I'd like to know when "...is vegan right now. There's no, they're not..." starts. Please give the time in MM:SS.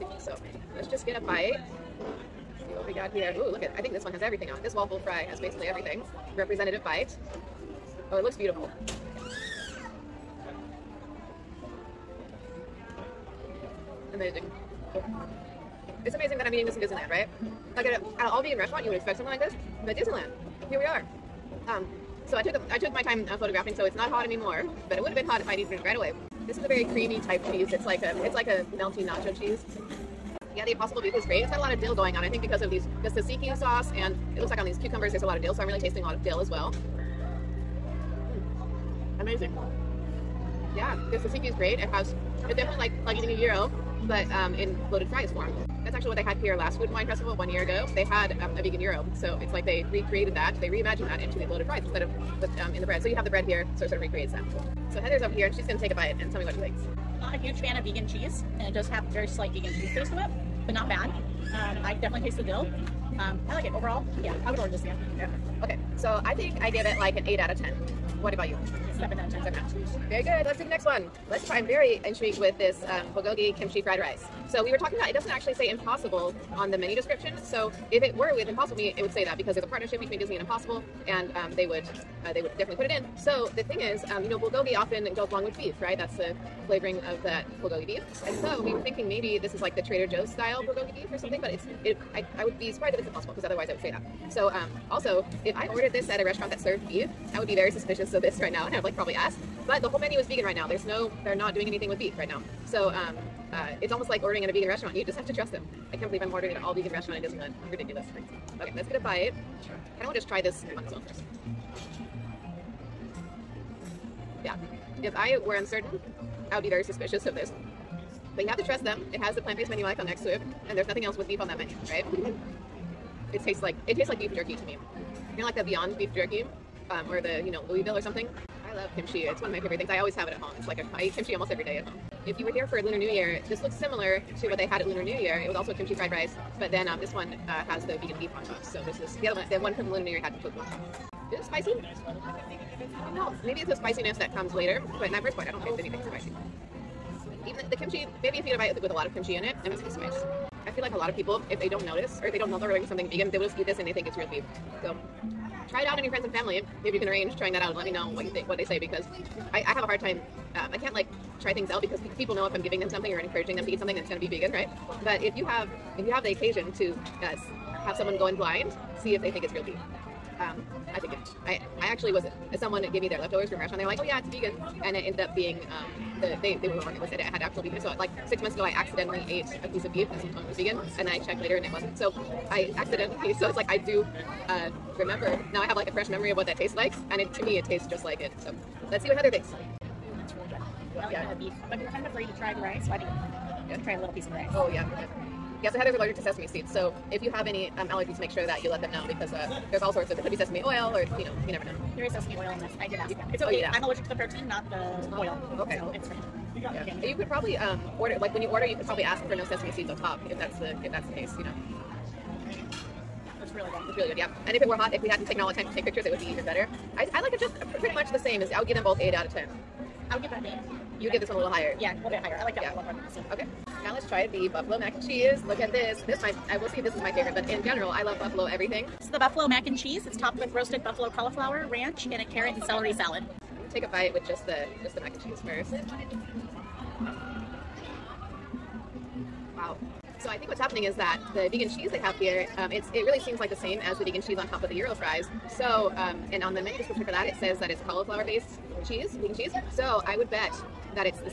01:40.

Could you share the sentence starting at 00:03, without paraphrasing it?
Ooh, look at, I think this one has everything on it.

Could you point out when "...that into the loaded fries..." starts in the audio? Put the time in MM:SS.
00:51.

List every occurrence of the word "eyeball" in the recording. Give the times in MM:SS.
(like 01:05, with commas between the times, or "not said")
not said.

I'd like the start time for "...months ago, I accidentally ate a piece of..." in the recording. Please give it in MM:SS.
02:58.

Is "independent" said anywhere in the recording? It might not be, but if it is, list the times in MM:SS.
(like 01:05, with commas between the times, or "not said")
not said.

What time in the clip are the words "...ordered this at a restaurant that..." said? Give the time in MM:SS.
01:35.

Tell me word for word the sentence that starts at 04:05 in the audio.
So um, and on the menu description for that, it says that it's cauliflower based cheese, vegan cheese.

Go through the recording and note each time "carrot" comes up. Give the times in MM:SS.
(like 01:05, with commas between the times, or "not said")
03:52.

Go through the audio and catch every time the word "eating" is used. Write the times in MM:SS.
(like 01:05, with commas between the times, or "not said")
00:16, 00:43.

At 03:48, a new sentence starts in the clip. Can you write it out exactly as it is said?
It's the buffalo mac and cheese.